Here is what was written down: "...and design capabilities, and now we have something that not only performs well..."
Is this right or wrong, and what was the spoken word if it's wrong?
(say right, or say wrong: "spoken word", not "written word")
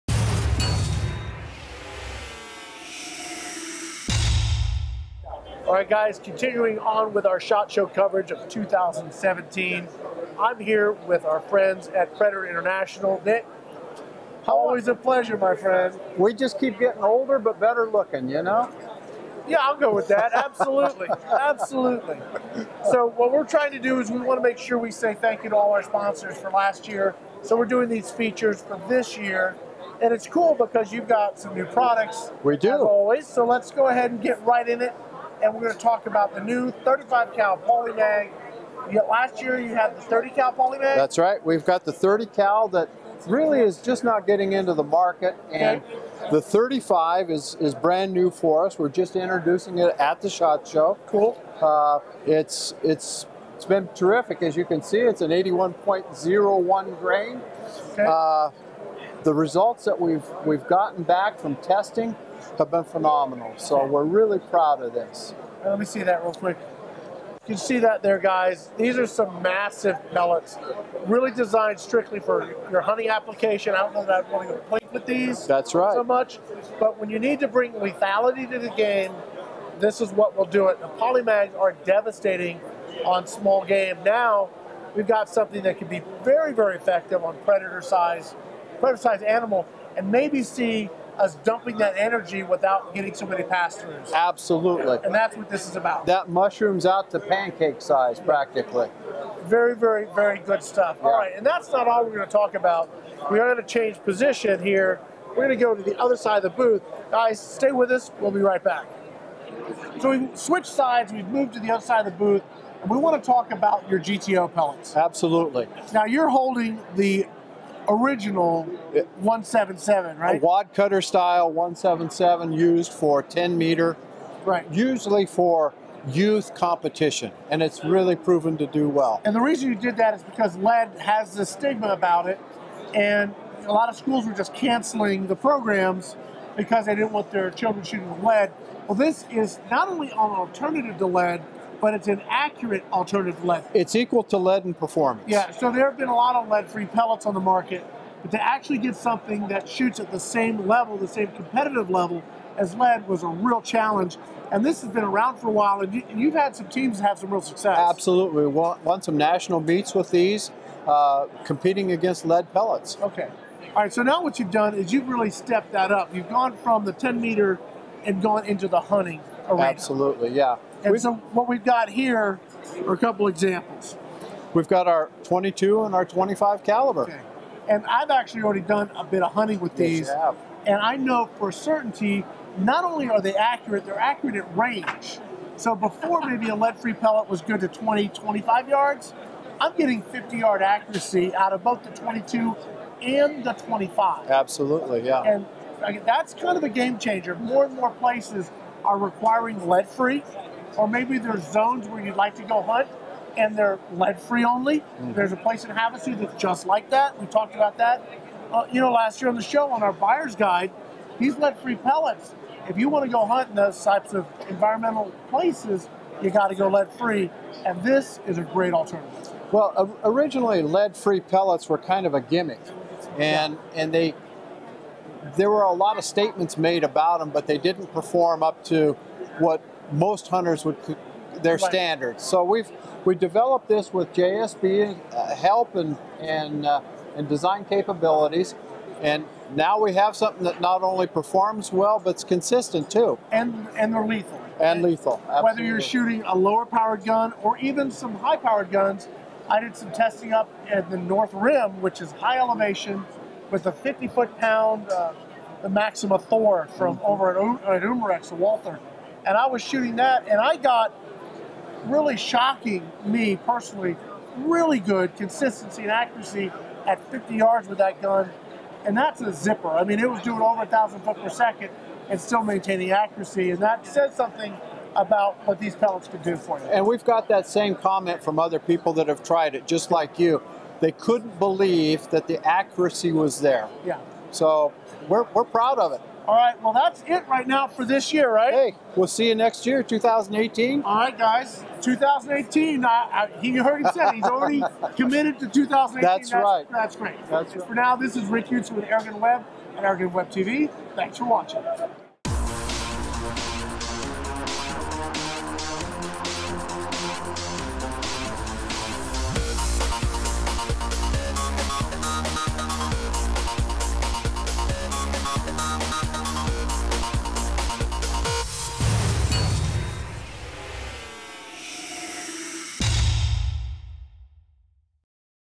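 right.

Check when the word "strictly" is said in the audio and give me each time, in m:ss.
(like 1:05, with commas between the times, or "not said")
1:11.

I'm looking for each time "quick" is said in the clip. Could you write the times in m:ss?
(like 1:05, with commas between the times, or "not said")
1:06.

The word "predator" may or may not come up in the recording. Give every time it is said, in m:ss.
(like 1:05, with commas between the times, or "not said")
0:12, 1:27.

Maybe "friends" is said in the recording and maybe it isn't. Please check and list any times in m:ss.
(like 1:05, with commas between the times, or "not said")
0:11, 0:15.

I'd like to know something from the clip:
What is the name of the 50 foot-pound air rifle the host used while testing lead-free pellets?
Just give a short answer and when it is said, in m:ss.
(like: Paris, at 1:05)
Maxima Thor, at 4:15.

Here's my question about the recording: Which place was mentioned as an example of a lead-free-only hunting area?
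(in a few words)
Havasu.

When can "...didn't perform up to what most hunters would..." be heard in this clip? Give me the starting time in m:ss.
3:47.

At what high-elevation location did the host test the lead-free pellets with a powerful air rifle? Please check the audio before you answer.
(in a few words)
North Rim.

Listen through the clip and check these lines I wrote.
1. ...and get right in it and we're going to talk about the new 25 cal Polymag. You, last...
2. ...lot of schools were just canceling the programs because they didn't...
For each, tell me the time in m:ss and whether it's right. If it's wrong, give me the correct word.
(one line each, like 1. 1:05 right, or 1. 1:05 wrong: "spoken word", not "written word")
1. 0:34 wrong: "35", not "25"
2. 2:13 right.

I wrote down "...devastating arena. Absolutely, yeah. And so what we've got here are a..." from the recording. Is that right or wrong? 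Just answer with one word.
wrong.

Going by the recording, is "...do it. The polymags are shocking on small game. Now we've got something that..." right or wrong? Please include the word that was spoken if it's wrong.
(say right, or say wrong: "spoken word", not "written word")
wrong: "devastating", not "shocking".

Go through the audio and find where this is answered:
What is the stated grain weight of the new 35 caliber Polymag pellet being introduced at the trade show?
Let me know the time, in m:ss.
0:55.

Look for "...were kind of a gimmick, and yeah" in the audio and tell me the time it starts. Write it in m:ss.
3:41.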